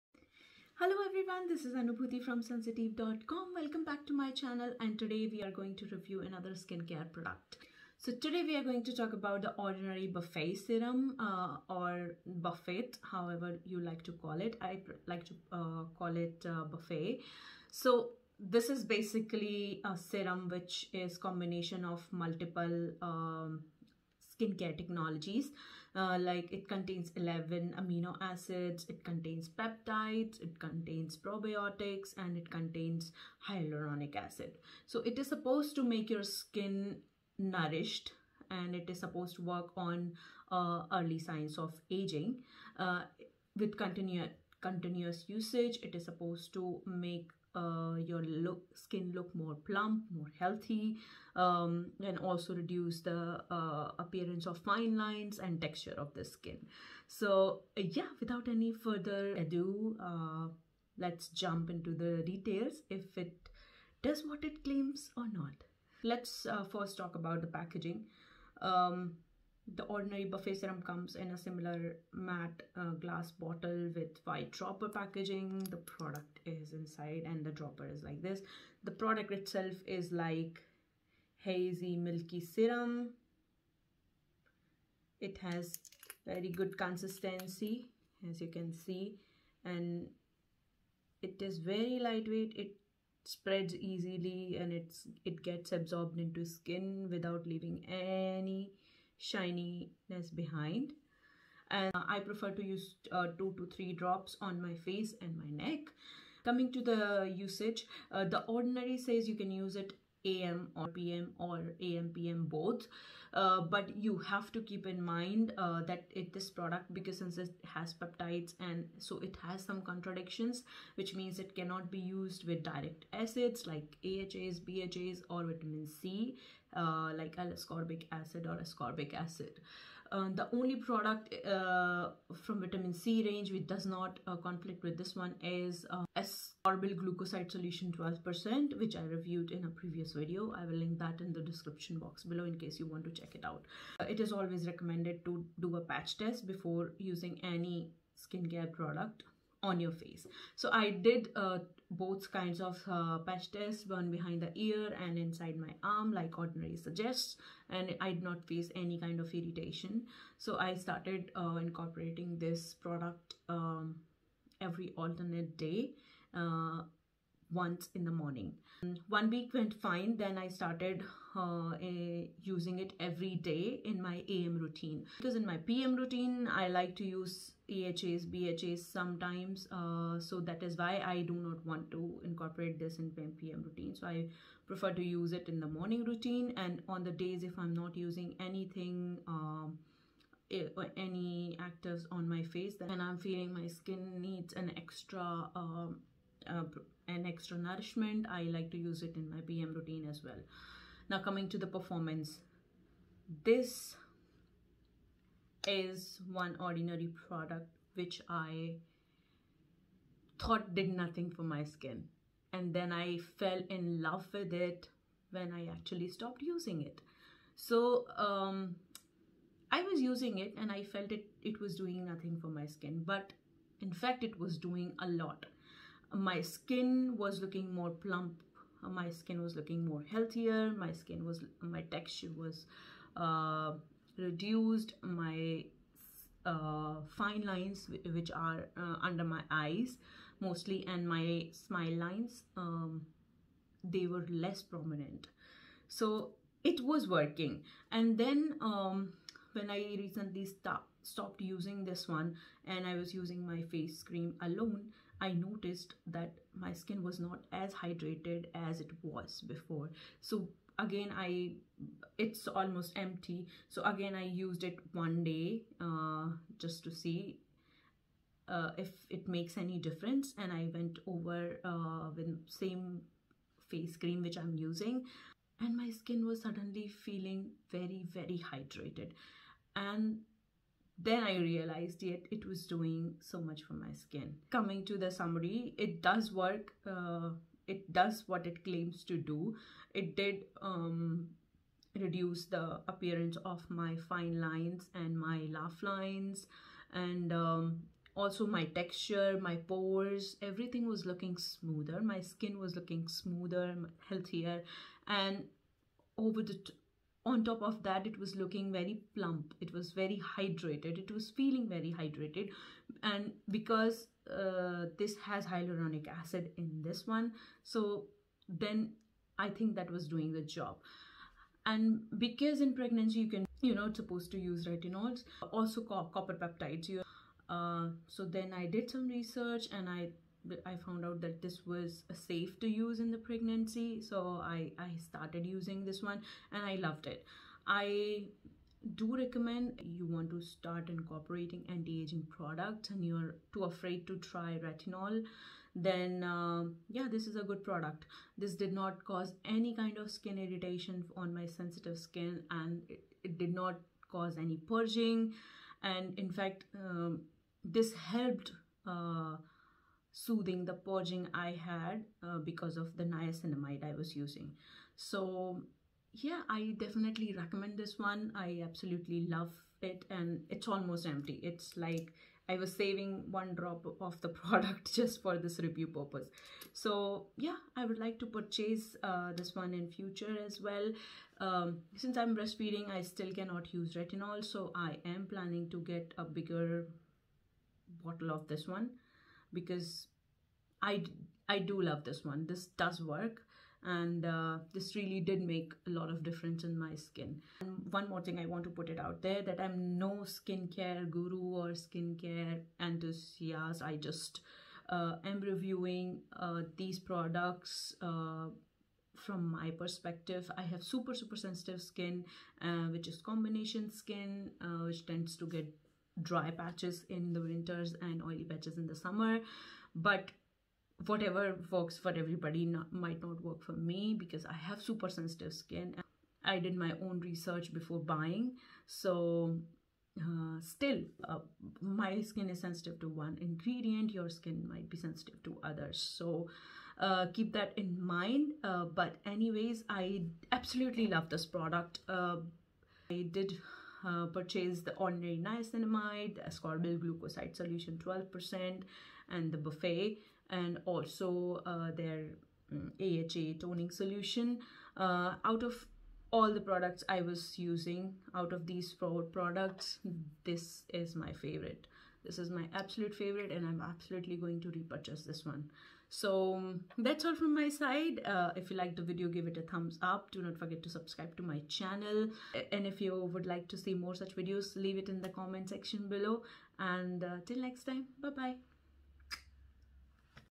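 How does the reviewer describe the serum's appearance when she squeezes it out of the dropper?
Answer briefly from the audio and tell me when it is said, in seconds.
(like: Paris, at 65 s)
Hazy milky, at 81 s.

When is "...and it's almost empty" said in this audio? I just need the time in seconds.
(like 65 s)
370 s.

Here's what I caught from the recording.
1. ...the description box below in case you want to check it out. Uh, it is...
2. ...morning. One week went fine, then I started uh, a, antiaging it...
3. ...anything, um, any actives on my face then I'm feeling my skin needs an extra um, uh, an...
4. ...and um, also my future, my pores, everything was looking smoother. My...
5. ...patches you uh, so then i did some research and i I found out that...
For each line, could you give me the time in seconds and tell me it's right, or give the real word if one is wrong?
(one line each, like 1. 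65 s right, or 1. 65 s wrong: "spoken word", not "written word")
1. 141 s right
2. 168 s wrong: "using", not "antiaging"
3. 188 s right
4. 296 s wrong: "texture", not "future"
5. 326 s wrong: "peptides", not "patches".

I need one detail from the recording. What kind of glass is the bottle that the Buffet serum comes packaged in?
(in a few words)
Matte.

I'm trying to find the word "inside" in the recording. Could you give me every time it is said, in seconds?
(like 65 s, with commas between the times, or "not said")
76 s, 155 s.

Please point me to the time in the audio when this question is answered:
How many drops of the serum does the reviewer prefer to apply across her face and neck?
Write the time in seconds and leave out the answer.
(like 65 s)
103 s.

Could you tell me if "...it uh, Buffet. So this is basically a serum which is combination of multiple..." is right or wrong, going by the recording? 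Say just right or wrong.
right.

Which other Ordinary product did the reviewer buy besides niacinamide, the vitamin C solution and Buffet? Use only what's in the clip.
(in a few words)
AHA toning solution.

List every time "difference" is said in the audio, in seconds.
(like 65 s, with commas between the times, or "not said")
269 s, 396 s.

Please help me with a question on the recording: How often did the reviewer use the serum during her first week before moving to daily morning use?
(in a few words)
Every alternate day.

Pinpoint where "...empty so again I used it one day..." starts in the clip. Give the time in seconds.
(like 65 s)
262 s.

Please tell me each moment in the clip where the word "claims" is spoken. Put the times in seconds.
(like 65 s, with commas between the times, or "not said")
64 s, 288 s.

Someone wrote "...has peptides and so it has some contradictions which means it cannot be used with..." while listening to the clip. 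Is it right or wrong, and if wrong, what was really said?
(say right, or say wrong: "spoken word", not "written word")
right.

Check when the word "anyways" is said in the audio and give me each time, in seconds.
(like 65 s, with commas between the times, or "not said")
439 s.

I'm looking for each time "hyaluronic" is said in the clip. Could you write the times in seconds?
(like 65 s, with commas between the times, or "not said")
33 s, 315 s.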